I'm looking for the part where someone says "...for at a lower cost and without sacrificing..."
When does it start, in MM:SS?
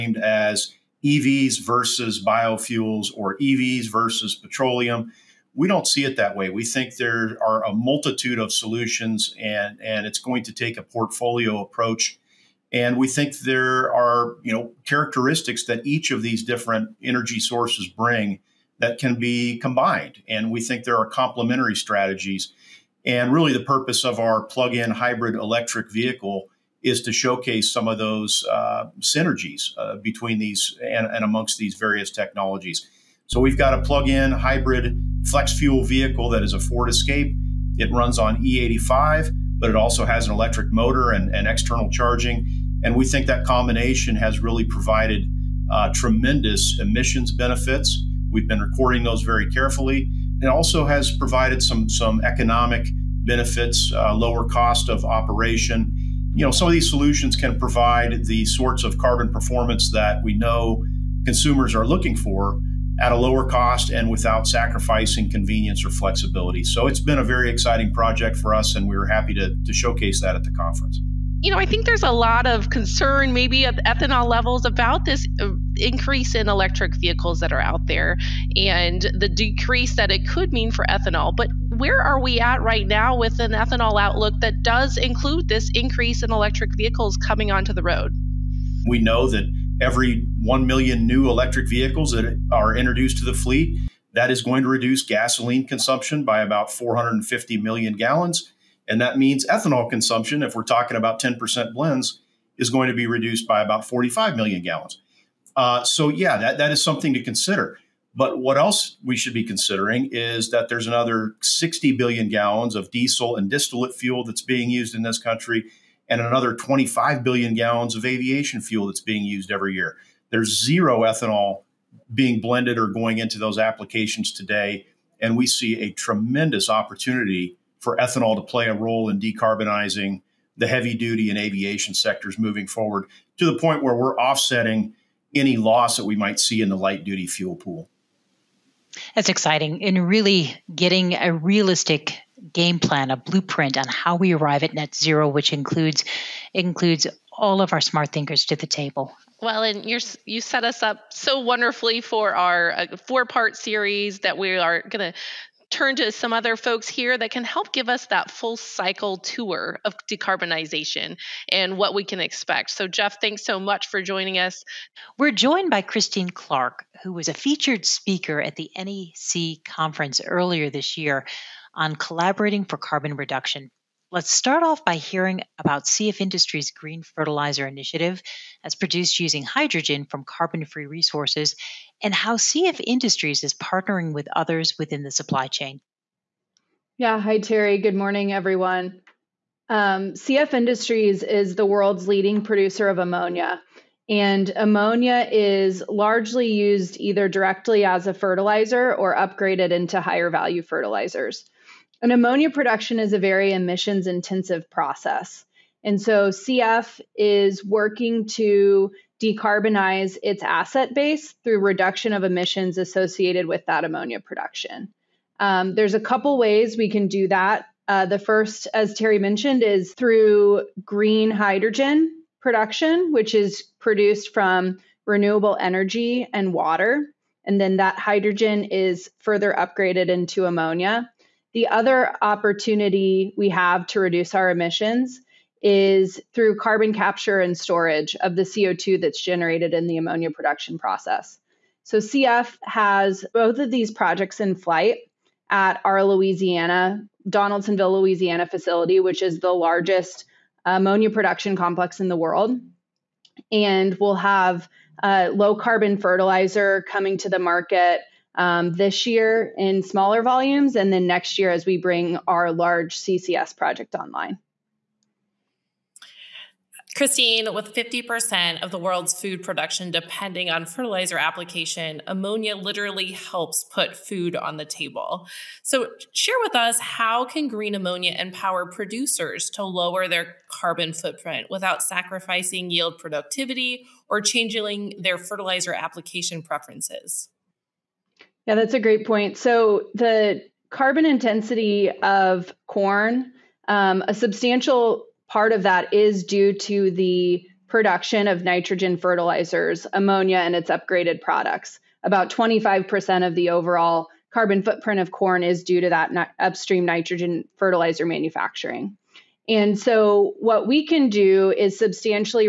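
01:02.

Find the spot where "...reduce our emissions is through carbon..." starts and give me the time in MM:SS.
03:53.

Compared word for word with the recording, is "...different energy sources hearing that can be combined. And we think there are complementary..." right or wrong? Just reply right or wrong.
wrong.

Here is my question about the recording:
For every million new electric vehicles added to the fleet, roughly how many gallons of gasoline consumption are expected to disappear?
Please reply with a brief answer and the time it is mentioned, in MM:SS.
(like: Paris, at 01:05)
450 million gallons, at 01:36.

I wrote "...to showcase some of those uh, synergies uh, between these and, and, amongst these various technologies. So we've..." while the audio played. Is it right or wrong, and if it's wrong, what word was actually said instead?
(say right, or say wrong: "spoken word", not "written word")
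right.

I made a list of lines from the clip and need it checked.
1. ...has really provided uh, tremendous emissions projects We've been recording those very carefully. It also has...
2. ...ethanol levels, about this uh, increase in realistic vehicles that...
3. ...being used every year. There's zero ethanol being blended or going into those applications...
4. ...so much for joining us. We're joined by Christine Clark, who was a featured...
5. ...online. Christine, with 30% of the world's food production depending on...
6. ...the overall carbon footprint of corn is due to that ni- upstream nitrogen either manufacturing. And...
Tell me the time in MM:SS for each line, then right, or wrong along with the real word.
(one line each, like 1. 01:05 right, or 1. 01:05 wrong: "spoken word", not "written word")
1. 00:44 wrong: "benefits", not "projects"
2. 01:13 wrong: "electric", not "realistic"
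3. 01:59 right
4. 02:43 right
5. 04:23 wrong: "50", not "30"
6. 05:03 wrong: "fertilizer", not "either".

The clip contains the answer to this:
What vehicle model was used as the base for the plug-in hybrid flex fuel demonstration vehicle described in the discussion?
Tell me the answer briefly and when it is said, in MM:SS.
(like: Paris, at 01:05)
Ford Escape, at 00:36.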